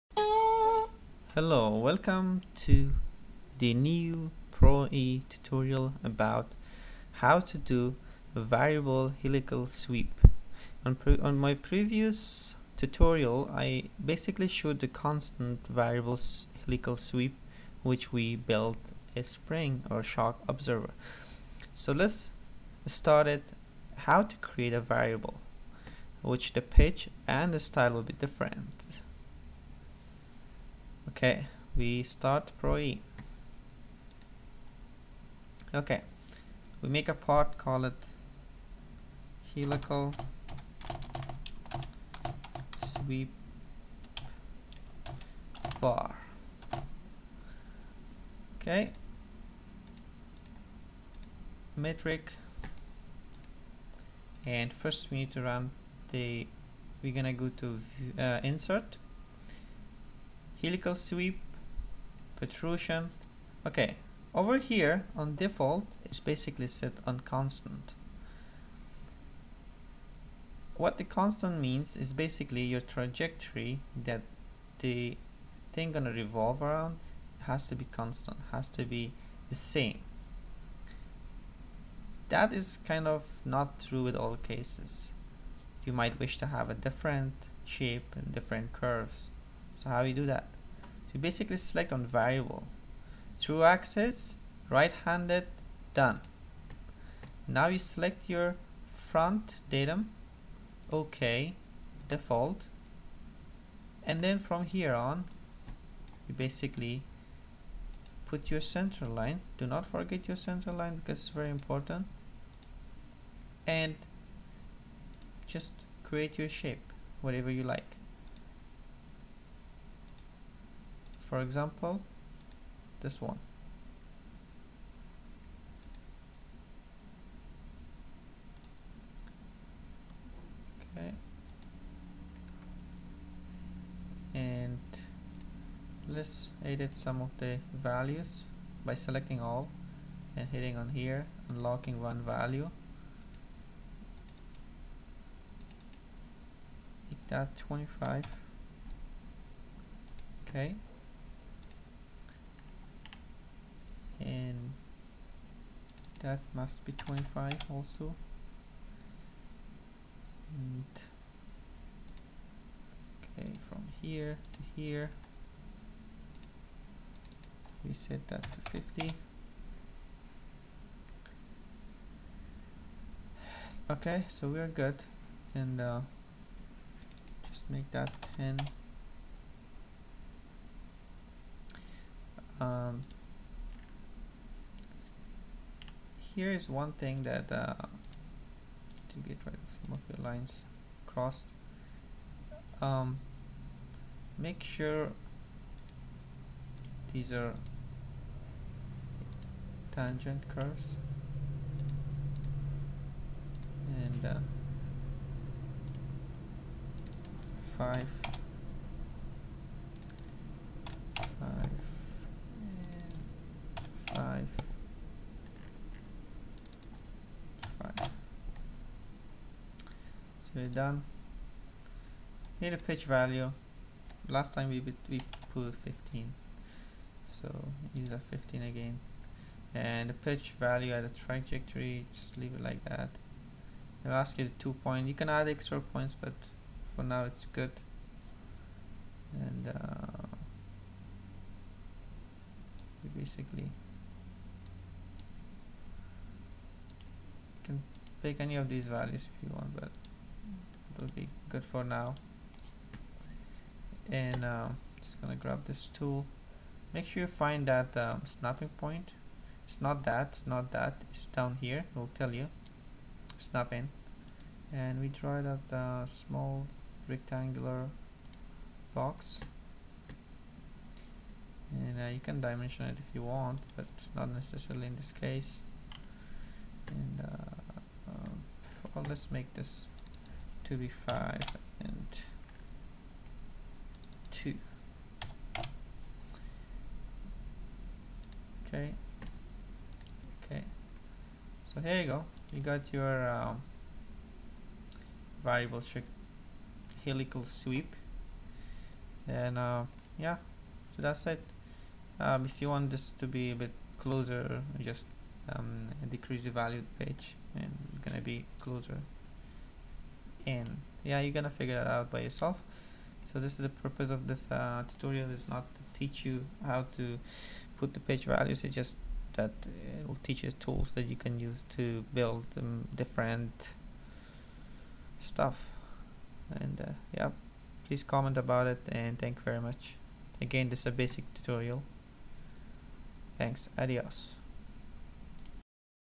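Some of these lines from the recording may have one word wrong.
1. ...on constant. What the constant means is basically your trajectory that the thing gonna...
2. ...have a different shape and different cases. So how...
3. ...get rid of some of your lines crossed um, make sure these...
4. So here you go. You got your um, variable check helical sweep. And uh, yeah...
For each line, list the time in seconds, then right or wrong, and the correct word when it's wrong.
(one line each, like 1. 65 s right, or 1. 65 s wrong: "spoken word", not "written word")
1. 67 s right
2. 86 s wrong: "curves", not "cases"
3. 189 s right
4. 291 s right.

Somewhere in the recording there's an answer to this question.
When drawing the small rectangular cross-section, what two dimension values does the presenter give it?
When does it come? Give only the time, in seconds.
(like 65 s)
280 s.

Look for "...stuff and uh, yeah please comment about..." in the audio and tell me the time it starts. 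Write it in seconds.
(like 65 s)
325 s.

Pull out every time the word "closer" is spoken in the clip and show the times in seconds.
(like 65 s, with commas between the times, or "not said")
303 s, 308 s.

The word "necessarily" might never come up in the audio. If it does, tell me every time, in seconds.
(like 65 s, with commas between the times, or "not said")
274 s.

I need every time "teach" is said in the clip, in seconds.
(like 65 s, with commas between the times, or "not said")
315 s, 320 s.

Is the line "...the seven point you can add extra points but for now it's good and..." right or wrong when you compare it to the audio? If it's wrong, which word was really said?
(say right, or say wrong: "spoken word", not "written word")
wrong: "two", not "seven".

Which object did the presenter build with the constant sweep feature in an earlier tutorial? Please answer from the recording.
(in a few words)
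shock absorber.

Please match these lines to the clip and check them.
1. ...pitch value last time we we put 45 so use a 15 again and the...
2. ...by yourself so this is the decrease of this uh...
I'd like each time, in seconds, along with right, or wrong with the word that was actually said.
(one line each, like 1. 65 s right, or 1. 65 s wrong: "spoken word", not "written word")
1. 222 s wrong: "15", not "45"
2. 312 s wrong: "purpose", not "decrease".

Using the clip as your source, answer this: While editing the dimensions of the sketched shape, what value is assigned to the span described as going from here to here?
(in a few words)
50.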